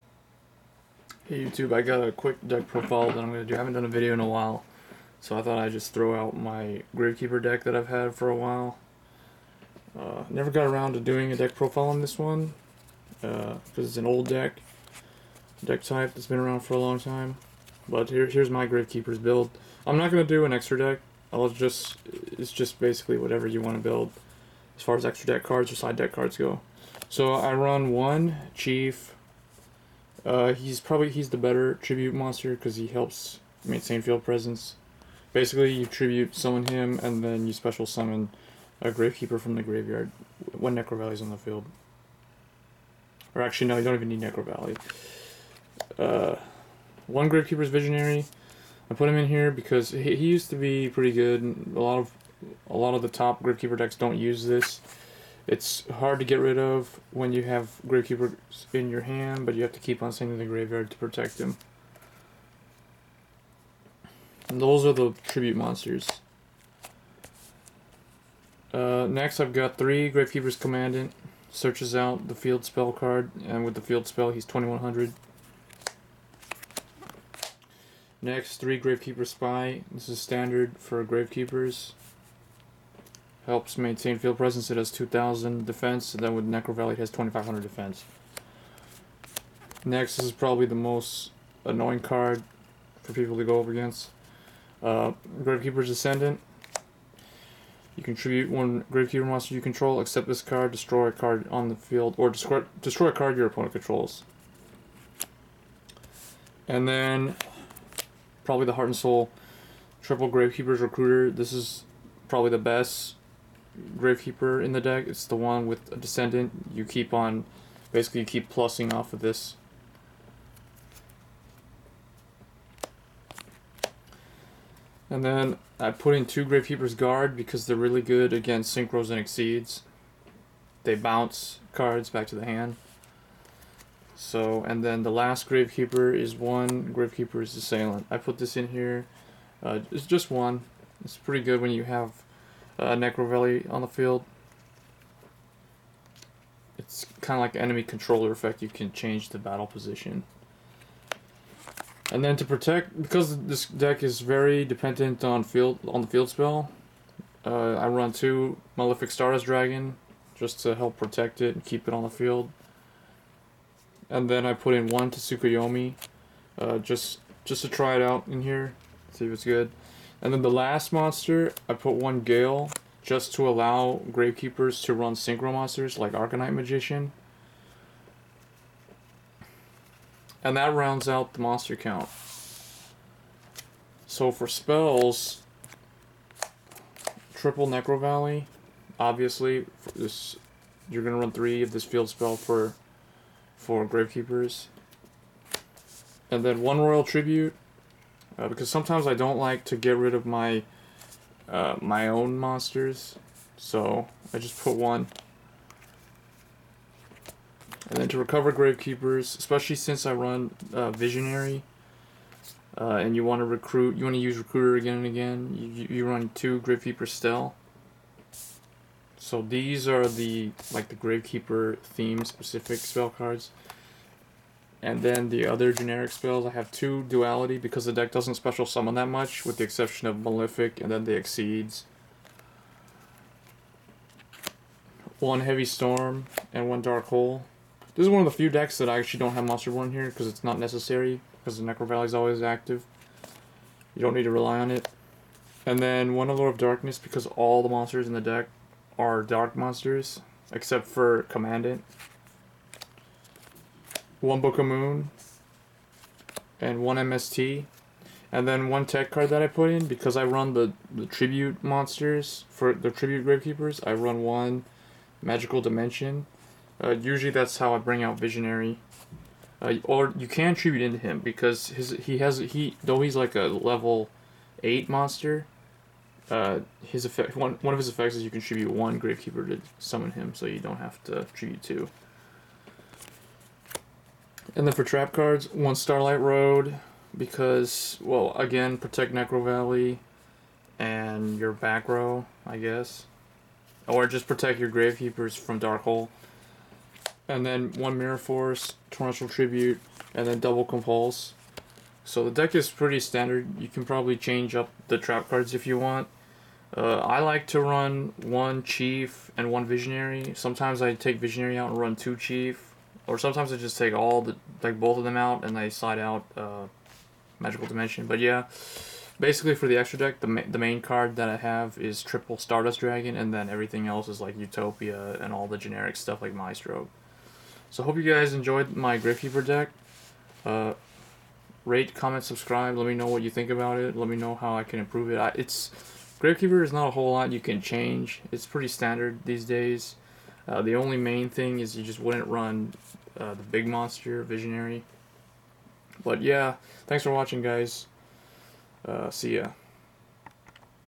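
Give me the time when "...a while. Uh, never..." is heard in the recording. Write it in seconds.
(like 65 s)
8 s.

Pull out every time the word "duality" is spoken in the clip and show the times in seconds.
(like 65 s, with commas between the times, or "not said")
227 s.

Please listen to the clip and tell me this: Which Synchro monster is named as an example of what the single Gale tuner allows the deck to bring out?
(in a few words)
Arcanite Magician.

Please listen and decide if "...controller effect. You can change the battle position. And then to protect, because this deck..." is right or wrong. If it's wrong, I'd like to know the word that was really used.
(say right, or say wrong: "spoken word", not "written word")
right.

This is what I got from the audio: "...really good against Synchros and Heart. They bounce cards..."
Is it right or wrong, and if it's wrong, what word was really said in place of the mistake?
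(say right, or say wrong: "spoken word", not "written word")
wrong: "Exceeds", not "Heart".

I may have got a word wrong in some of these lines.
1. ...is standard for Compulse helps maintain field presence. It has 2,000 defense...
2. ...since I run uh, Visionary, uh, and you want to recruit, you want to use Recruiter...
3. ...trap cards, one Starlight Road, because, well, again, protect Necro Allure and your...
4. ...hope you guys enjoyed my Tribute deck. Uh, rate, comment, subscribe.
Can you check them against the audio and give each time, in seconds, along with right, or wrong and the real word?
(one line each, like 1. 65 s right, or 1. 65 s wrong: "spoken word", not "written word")
1. 80 s wrong: "Gravekeepers", not "Compulse"
2. 209 s right
3. 284 s wrong: "Valley", not "Allure"
4. 327 s wrong: "Gravekeeper", not "Tribute".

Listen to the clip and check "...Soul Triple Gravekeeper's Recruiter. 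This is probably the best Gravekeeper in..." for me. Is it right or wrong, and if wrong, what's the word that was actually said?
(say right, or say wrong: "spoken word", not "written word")
right.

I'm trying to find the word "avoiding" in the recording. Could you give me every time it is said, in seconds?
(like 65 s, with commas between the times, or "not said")
not said.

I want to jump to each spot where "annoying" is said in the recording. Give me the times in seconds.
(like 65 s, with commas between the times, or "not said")
91 s.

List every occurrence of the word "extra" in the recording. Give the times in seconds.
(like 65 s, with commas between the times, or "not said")
20 s, 25 s, 319 s.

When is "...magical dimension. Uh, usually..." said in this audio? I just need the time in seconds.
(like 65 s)
265 s.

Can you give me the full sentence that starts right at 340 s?
Uh, the only main thing is you just wouldn't run uh, the big monster, Visionary.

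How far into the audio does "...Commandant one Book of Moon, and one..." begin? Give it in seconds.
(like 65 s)
251 s.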